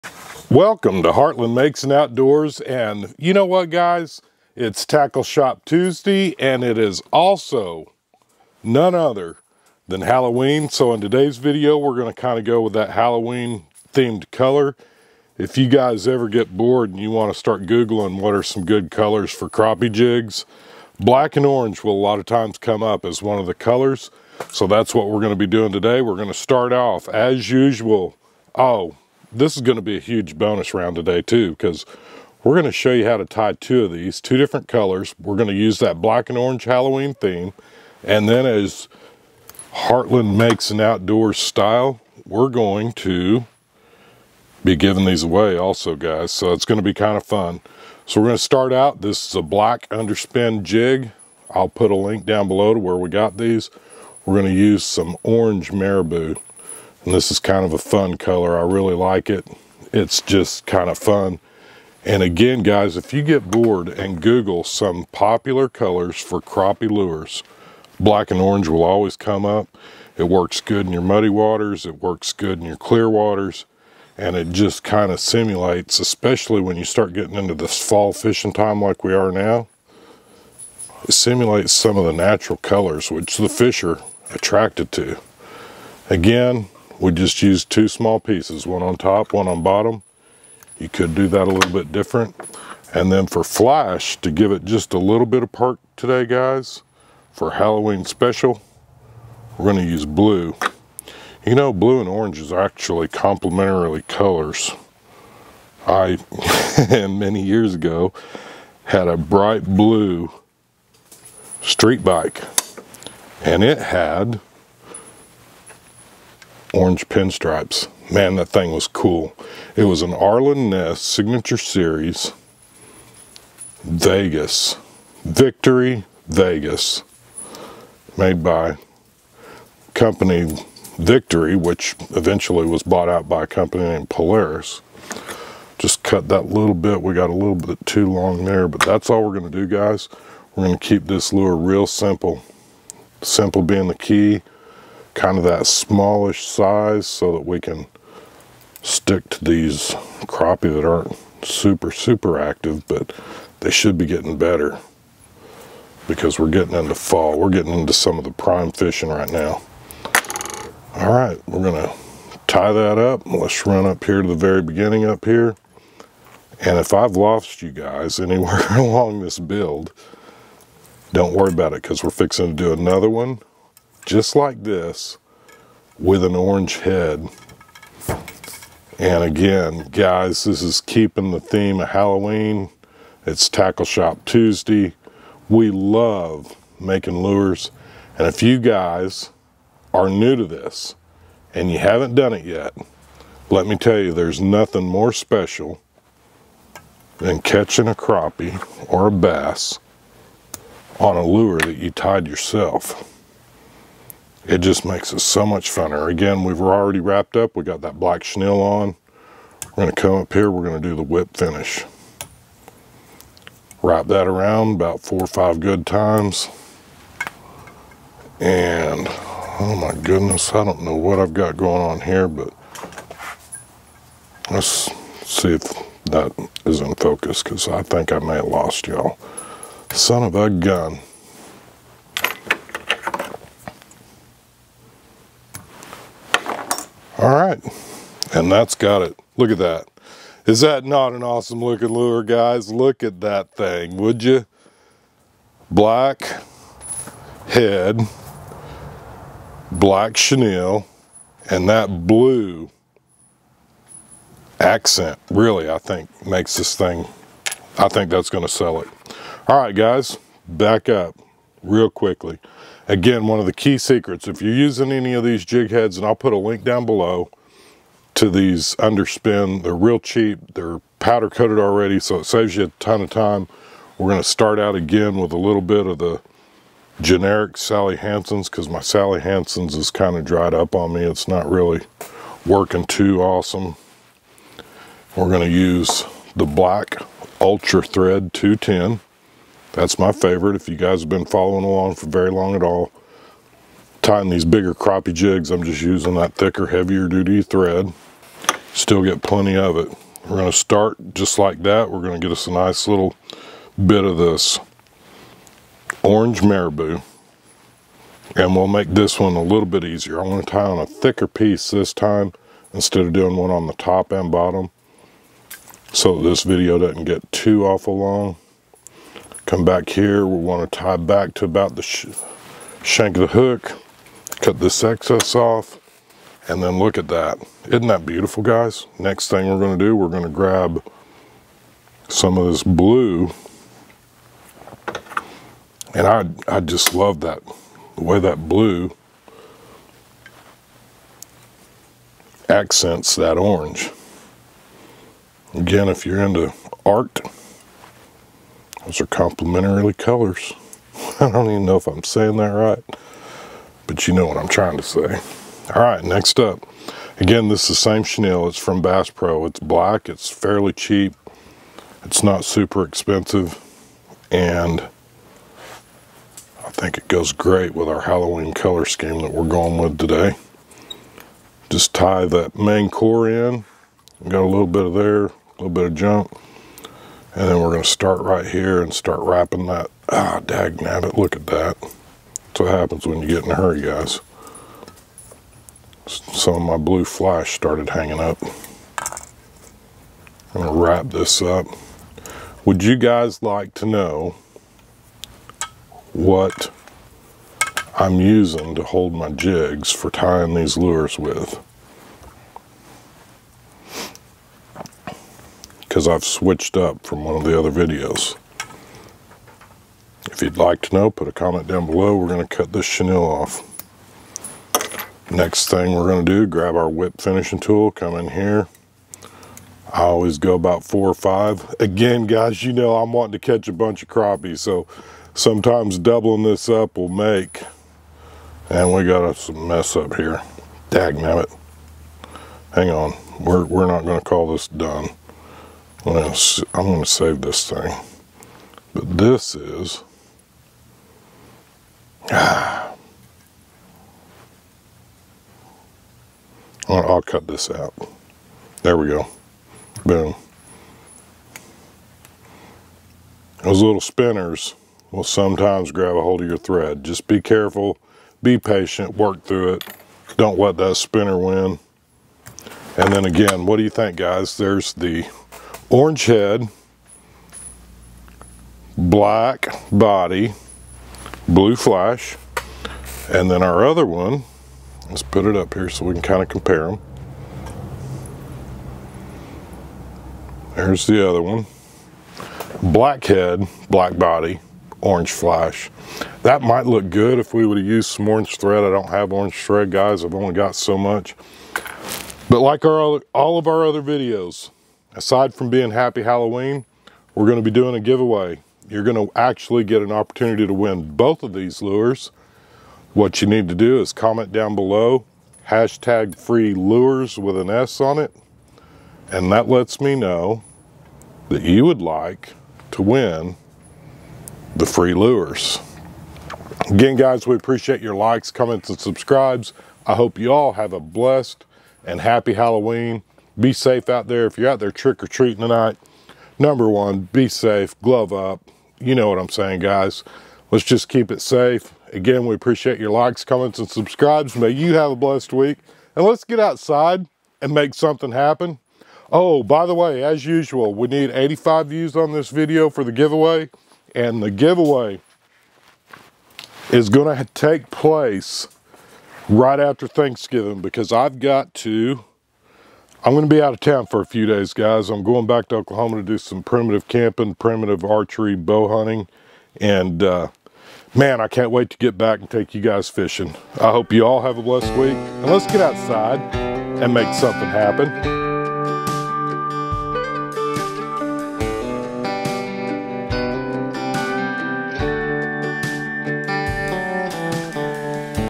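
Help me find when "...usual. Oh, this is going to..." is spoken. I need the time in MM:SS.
00:27.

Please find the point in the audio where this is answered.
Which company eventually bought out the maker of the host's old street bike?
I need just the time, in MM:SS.
02:14.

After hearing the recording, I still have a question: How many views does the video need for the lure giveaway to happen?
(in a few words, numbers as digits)
85.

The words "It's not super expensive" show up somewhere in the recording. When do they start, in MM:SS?
06:02.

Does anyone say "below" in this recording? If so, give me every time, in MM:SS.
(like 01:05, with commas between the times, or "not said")
00:52, 04:26, 06:51, 08:24.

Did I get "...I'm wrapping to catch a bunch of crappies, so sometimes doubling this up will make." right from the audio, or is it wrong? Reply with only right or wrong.
wrong.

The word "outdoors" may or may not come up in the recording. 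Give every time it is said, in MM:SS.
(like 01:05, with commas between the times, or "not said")
00:01, 00:40.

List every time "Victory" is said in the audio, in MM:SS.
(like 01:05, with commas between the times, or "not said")
02:05, 02:10.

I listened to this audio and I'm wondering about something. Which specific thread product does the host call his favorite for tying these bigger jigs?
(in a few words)
Ultra Thread 210.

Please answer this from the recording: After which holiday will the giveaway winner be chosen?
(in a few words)
Thanksgiving.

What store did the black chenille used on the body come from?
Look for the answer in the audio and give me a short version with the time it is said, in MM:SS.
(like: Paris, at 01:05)
Bass Pro, at 05:58.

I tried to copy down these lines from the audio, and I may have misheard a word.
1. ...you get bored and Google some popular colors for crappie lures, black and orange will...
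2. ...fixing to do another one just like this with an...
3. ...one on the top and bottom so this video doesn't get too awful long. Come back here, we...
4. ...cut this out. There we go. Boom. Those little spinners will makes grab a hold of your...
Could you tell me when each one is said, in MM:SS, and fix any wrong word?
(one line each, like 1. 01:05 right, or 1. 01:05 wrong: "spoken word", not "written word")
1. 01:03 right
2. 02:52 right
3. 05:13 right
4. 07:27 wrong: "sometimes", not "makes".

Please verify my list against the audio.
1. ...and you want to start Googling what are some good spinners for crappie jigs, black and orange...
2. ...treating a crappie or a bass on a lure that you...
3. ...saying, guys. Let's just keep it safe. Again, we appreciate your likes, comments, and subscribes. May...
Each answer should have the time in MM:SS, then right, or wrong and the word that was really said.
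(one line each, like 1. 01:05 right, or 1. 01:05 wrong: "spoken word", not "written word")
1. 00:16 wrong: "colors", not "spinners"
2. 03:17 wrong: "catching", not "treating"
3. 08:49 right.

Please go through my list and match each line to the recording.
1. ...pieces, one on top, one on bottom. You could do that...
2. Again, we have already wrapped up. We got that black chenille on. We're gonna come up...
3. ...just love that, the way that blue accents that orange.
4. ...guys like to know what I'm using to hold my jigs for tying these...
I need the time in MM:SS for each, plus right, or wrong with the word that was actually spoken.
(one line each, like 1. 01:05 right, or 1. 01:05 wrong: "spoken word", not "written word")
1. 01:28 right
2. 03:26 right
3. 05:36 right
4. 06:32 right.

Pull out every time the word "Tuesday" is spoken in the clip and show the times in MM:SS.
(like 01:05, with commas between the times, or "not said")
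00:05, 03:04.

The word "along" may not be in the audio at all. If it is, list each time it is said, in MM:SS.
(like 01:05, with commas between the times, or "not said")
02:48, 04:51.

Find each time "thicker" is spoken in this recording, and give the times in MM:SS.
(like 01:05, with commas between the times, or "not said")
04:56, 05:10.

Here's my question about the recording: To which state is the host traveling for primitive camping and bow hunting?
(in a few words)
Oklahoma.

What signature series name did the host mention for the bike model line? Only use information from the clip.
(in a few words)
Arlen Ness.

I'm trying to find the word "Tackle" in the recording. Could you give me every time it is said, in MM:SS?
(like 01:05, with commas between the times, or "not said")
00:04, 03:03.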